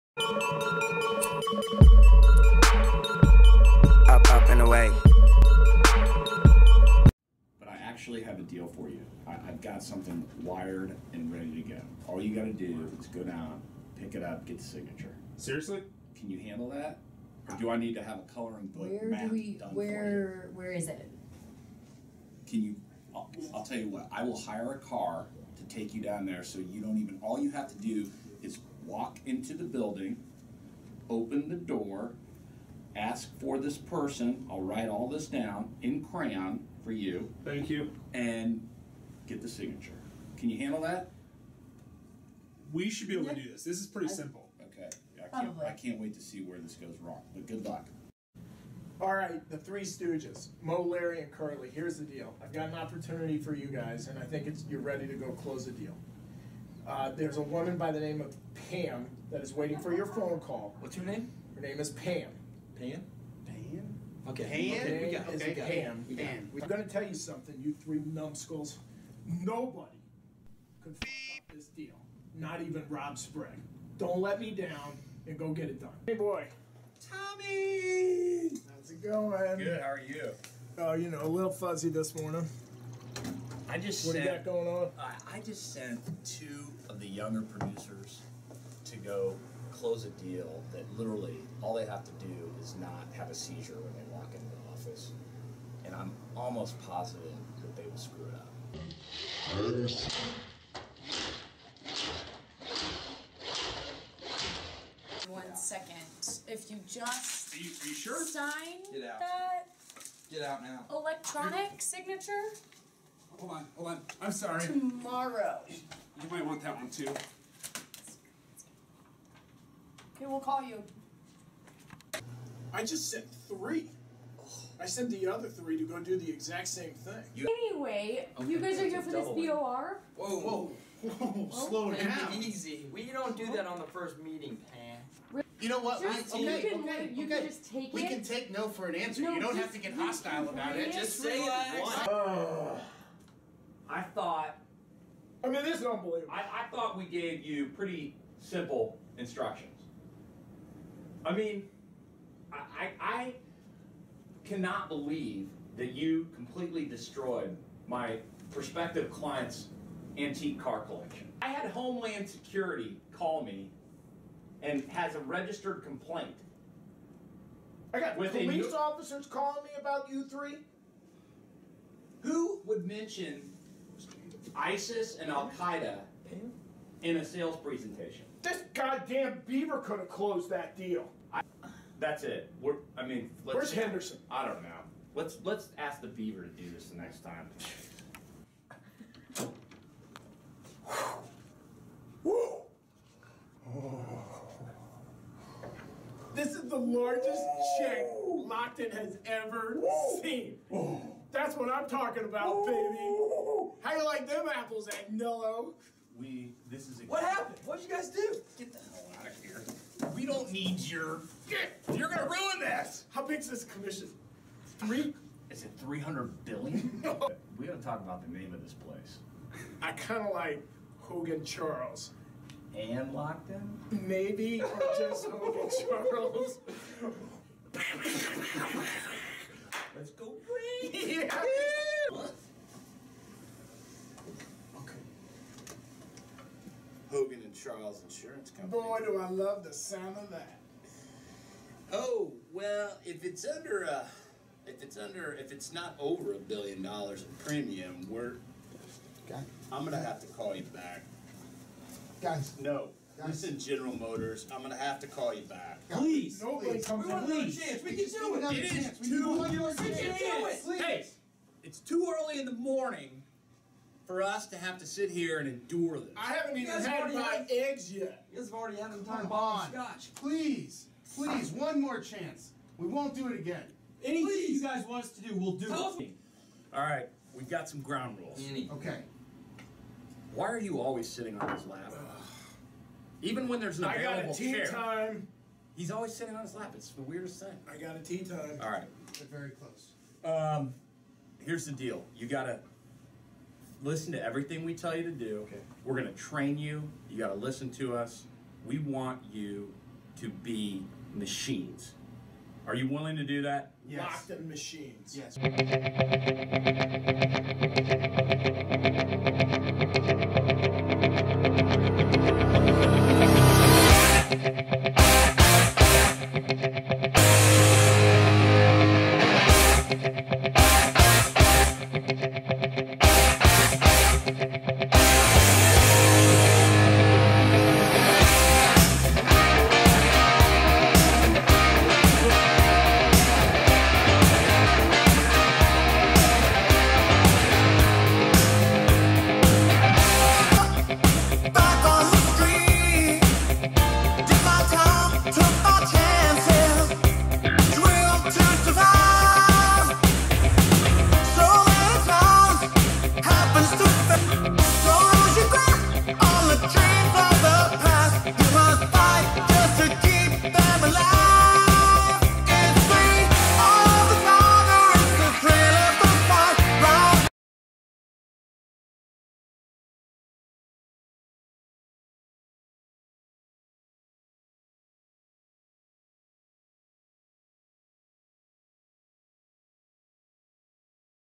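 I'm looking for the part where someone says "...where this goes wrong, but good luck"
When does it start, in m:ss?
0:46.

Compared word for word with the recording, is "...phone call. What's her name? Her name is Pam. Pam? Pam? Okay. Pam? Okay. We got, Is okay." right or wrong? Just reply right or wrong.
right.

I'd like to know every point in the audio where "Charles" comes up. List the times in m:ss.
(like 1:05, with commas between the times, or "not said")
3:41, 3:46.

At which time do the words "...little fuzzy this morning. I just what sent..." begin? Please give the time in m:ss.
1:21.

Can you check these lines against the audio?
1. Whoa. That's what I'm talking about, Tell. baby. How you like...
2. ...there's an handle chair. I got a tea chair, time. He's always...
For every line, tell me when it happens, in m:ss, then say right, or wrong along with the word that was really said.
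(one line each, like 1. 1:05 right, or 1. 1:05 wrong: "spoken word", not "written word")
1. 3:20 wrong: "Whoa", not "Tell"
2. 4:43 wrong: "available", not "handle".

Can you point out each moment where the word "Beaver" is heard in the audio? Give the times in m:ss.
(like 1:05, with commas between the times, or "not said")
2:59, 3:06.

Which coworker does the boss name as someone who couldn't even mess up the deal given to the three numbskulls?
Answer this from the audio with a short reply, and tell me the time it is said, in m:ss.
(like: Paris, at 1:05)
Rob Sprague, at 1:12.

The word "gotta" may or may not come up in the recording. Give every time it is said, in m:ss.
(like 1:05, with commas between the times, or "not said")
0:12, 3:37, 4:52.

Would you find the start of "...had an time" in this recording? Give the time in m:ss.
4:28.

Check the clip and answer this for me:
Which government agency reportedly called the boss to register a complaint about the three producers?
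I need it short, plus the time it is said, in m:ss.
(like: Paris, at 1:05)
Homeland Security, at 2:41.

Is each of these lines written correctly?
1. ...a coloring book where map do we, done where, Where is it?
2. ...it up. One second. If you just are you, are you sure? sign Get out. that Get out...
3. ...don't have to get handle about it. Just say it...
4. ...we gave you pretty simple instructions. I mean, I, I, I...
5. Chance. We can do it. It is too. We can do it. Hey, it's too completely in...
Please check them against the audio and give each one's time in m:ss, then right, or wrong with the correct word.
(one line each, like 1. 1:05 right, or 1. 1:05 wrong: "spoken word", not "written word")
1. 0:18 right
2. 1:38 right
3. 2:19 wrong: "hostile", not "handle"
4. 2:26 right
5. 4:17 wrong: "early", not "completely".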